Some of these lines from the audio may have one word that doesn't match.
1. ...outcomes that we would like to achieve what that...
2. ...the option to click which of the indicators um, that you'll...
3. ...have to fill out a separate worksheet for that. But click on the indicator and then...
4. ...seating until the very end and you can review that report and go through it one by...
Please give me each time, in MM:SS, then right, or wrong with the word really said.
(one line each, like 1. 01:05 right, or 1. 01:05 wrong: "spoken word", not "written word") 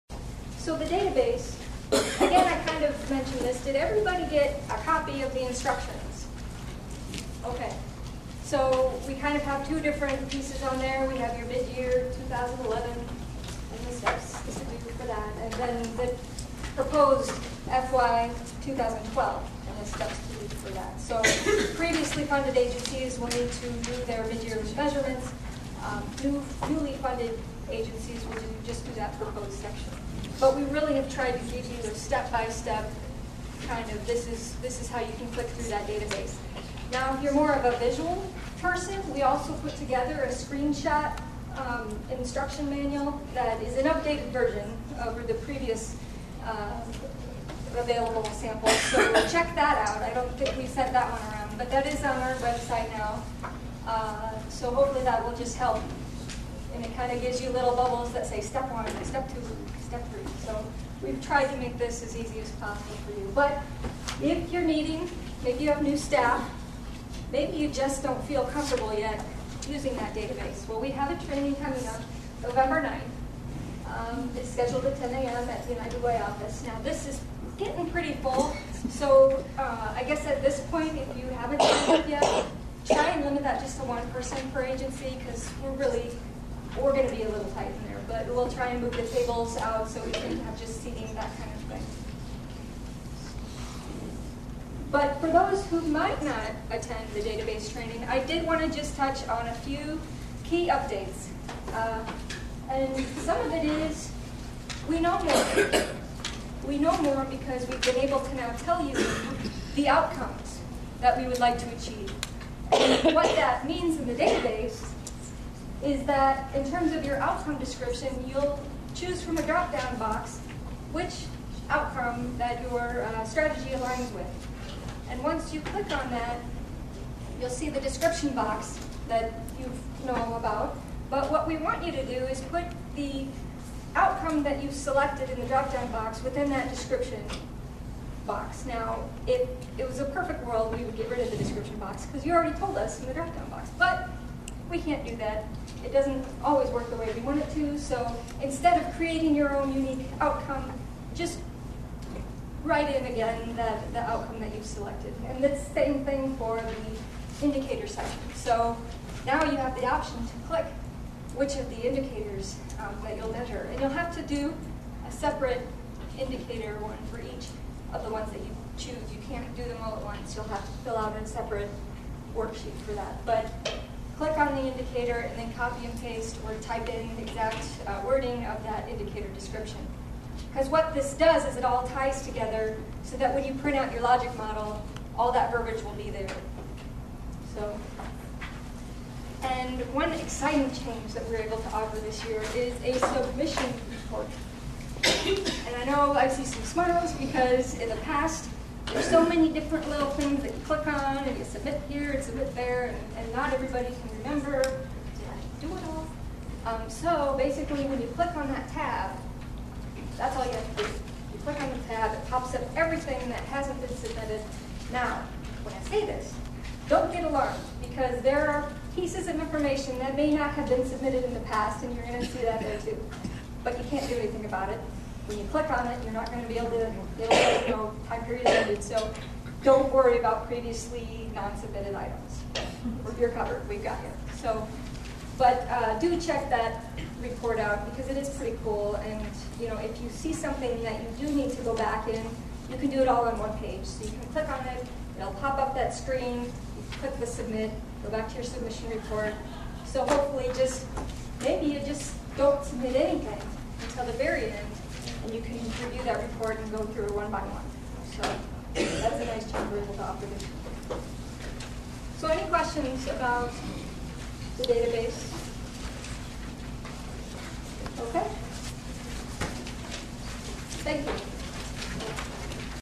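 1. 01:49 right
2. 02:39 right
3. 02:50 right
4. 04:12 wrong: "anything", not "seating".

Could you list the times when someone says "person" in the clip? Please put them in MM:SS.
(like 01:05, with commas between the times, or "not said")
00:38, 01:24.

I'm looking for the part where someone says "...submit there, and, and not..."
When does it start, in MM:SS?
03:22.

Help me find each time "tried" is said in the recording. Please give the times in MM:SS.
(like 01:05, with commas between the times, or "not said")
00:31, 01:01.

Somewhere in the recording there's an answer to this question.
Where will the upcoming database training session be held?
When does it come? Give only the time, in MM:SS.
01:15.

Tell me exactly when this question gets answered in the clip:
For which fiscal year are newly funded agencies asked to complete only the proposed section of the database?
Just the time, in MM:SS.
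00:17.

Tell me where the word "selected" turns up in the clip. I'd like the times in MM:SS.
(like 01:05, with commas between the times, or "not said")
02:14, 02:34.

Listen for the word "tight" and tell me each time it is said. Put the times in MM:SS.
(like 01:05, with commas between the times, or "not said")
01:27.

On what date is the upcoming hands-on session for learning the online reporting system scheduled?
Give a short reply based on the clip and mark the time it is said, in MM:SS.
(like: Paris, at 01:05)
November 9th, at 01:12.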